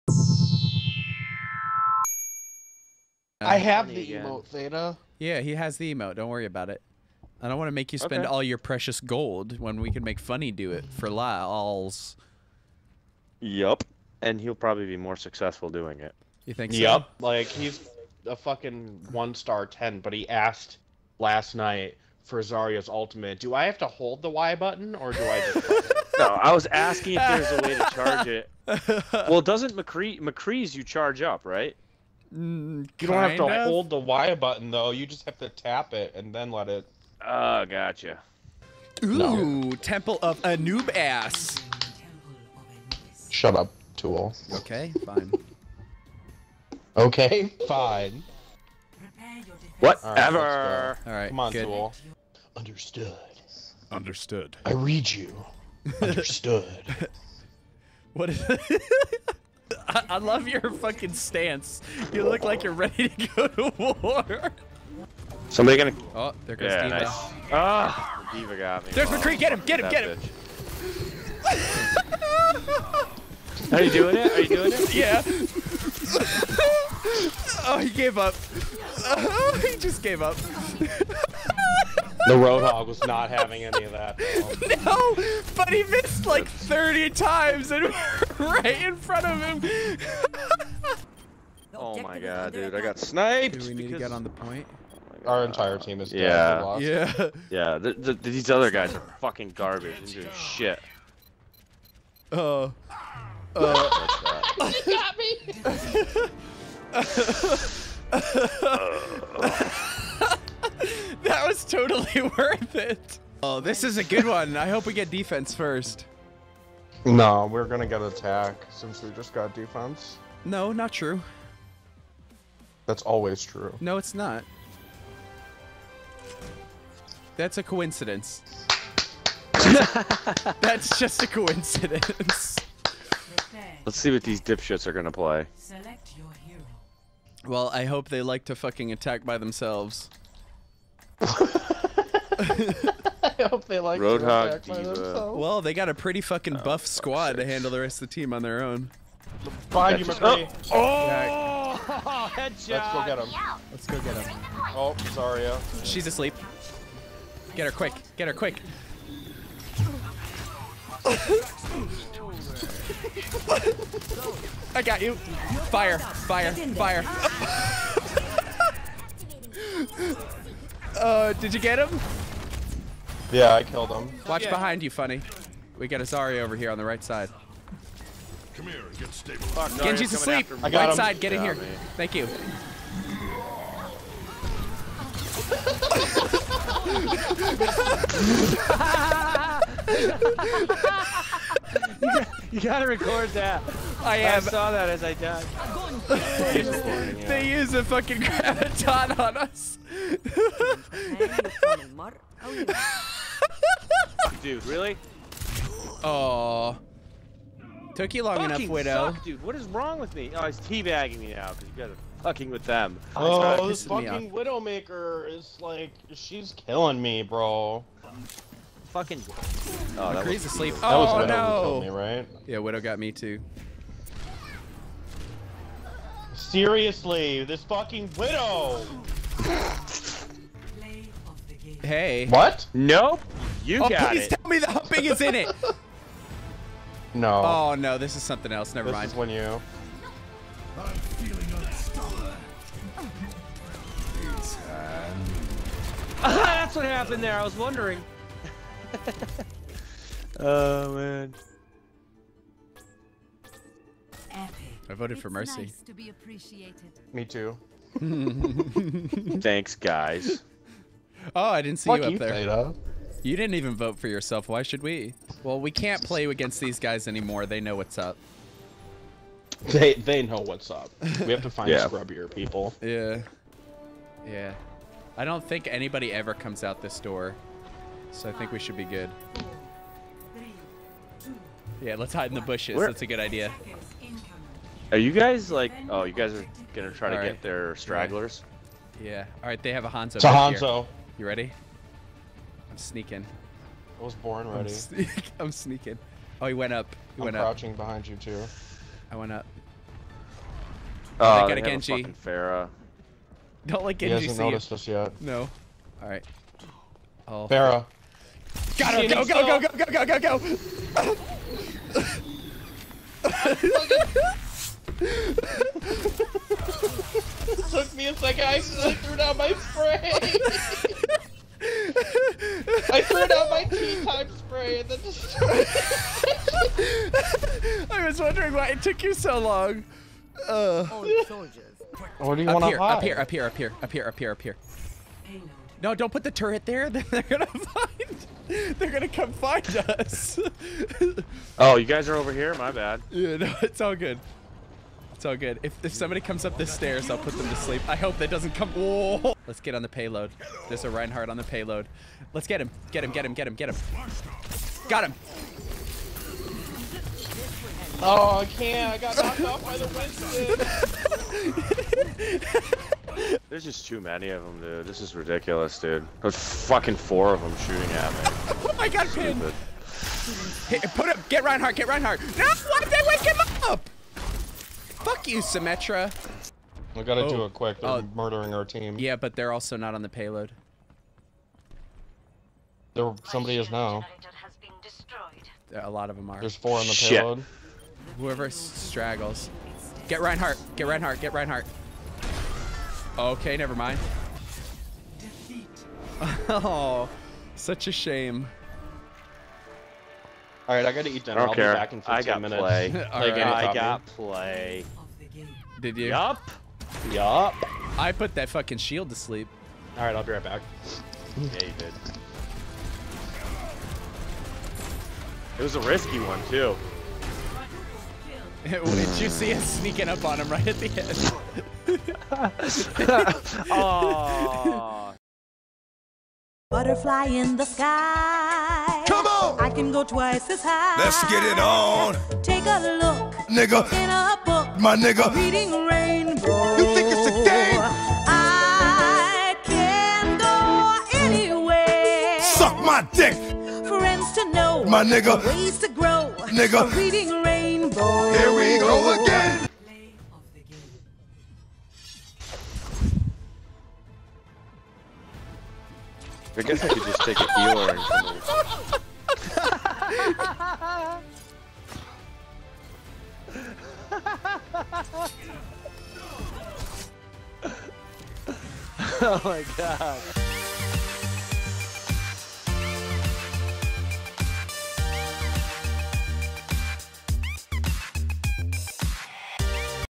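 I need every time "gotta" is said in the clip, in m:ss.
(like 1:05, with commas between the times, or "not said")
3:12, 6:17, 6:40.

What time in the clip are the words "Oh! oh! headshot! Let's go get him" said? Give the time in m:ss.
2:30.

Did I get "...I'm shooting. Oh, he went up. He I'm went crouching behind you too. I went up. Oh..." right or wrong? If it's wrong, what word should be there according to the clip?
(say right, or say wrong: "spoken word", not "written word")
wrong: "sneaking", not "shooting".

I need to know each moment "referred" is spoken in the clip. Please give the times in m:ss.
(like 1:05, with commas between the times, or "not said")
not said.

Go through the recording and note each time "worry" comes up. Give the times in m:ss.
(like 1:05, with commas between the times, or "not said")
0:06.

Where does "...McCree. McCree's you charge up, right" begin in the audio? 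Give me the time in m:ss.
0:29.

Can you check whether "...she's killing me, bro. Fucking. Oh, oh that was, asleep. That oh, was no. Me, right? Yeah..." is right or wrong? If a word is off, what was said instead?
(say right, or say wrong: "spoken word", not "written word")
right.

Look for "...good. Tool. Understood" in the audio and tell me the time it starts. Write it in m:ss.
0:51.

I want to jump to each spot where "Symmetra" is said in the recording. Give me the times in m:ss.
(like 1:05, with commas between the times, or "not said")
6:15.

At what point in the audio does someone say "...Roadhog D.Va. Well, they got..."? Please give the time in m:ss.
2:24.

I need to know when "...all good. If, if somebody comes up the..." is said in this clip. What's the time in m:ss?
5:45.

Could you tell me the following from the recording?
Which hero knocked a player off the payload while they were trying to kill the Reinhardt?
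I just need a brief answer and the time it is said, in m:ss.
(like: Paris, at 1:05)
Winston, at 5:59.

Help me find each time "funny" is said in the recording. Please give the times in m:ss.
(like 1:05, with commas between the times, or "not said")
0:10, 2:54.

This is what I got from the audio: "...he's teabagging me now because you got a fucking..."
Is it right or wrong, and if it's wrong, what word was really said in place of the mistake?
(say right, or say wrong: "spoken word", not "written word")
right.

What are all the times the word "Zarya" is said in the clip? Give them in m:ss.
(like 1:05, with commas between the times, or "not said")
0:22, 2:56.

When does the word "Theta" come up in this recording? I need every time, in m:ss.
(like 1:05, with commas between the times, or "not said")
0:04, 4:22.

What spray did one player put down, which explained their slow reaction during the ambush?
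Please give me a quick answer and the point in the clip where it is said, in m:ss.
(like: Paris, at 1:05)
tea time spray, at 5:23.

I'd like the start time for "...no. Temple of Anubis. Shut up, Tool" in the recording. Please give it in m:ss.
0:39.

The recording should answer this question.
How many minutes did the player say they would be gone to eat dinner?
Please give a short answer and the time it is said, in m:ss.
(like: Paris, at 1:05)
15, at 6:42.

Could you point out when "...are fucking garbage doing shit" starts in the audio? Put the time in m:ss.
1:38.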